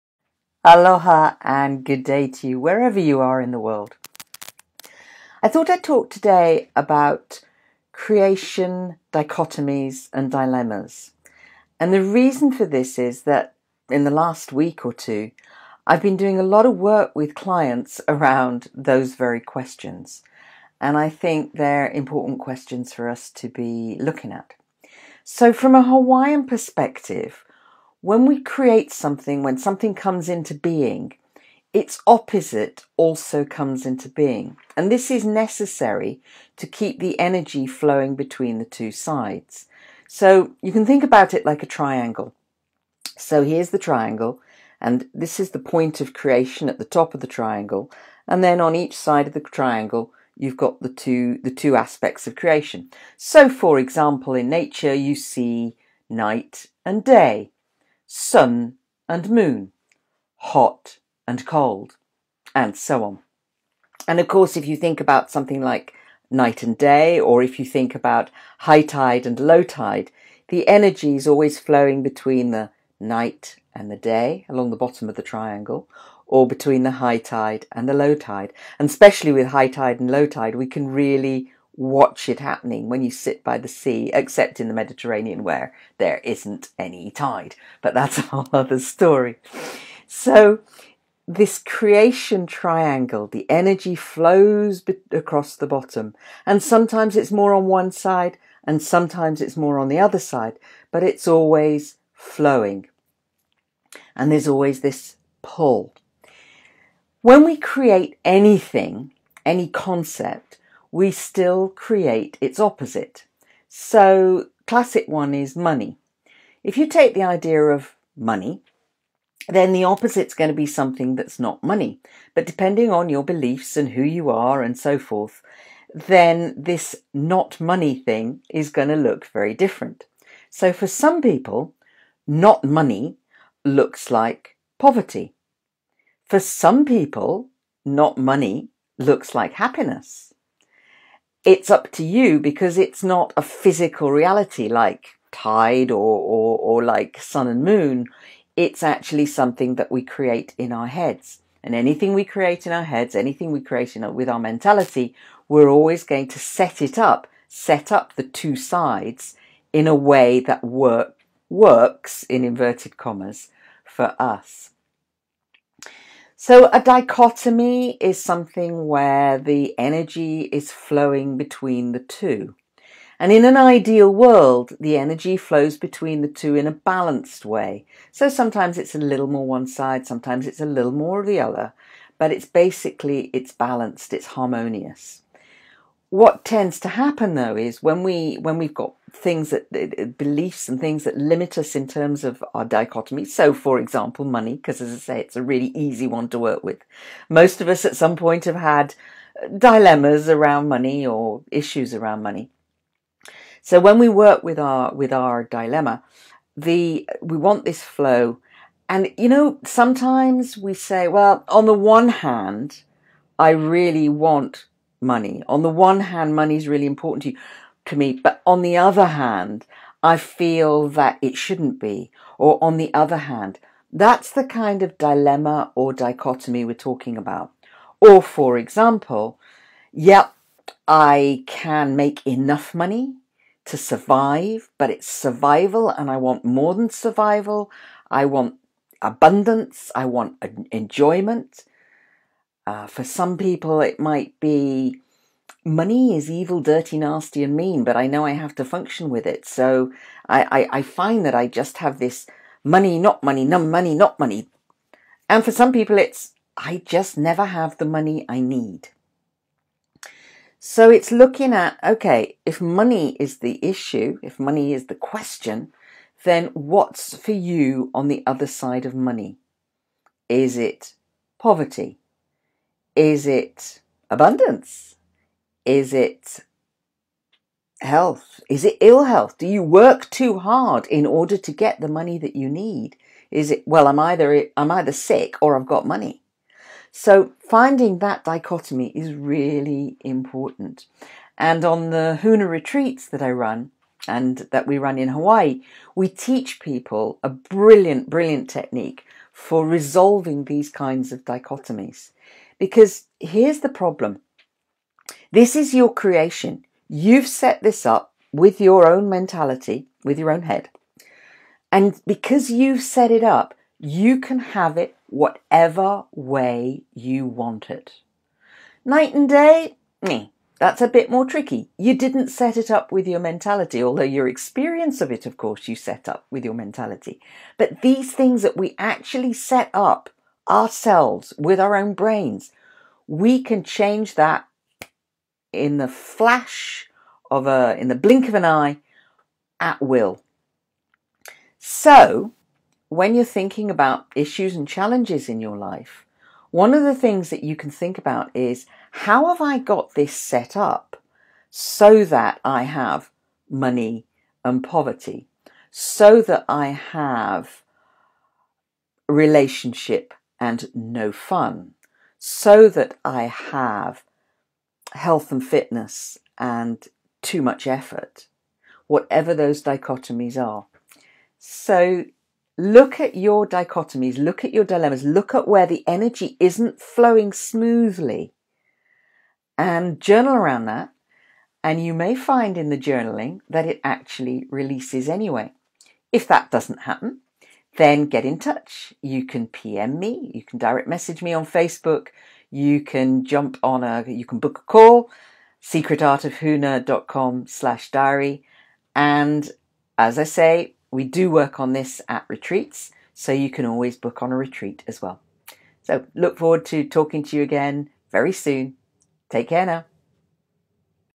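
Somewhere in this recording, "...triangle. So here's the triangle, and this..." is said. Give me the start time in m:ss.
0:41.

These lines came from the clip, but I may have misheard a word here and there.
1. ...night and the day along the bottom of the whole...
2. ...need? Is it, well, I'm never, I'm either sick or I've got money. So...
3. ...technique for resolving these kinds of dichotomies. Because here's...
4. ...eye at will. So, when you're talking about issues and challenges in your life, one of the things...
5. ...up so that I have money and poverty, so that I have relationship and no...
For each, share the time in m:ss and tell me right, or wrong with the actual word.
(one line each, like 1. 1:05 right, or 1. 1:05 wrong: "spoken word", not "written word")
1. 1:12 wrong: "triangle", not "whole"
2. 4:42 wrong: "either", not "never"
3. 4:58 right
4. 5:38 wrong: "thinking", not "talking"
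5. 5:50 right.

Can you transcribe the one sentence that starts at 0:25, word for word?
So, from a Hawaiian perspective, when we create something, when something comes into being, its opposite also comes into being.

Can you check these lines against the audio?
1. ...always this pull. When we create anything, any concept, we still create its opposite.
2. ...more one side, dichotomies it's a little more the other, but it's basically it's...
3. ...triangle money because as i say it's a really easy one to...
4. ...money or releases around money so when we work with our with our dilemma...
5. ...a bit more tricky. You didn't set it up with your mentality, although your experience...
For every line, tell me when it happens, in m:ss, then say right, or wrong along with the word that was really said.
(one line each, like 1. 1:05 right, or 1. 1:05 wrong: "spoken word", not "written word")
1. 1:44 right
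2. 2:59 wrong: "sometimes", not "dichotomies"
3. 3:13 wrong: "example", not "triangle"
4. 3:20 wrong: "issues", not "releases"
5. 5:20 right.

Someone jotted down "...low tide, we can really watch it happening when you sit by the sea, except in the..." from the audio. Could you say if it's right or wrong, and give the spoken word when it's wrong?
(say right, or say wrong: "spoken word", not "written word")
right.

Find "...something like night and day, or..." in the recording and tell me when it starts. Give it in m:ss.
1:05.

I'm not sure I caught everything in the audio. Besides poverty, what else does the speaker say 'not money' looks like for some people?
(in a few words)
Happiness.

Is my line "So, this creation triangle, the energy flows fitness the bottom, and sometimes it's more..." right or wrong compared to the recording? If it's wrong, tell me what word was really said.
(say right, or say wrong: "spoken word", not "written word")
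wrong: "across", not "fitness".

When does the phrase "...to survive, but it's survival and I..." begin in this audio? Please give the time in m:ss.
3:53.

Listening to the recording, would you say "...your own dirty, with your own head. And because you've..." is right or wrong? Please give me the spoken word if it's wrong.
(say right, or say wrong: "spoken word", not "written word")
wrong: "mentality", not "dirty".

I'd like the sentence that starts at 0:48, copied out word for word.
And then on each side of the triangle, you've got the two, the two aspects of creation.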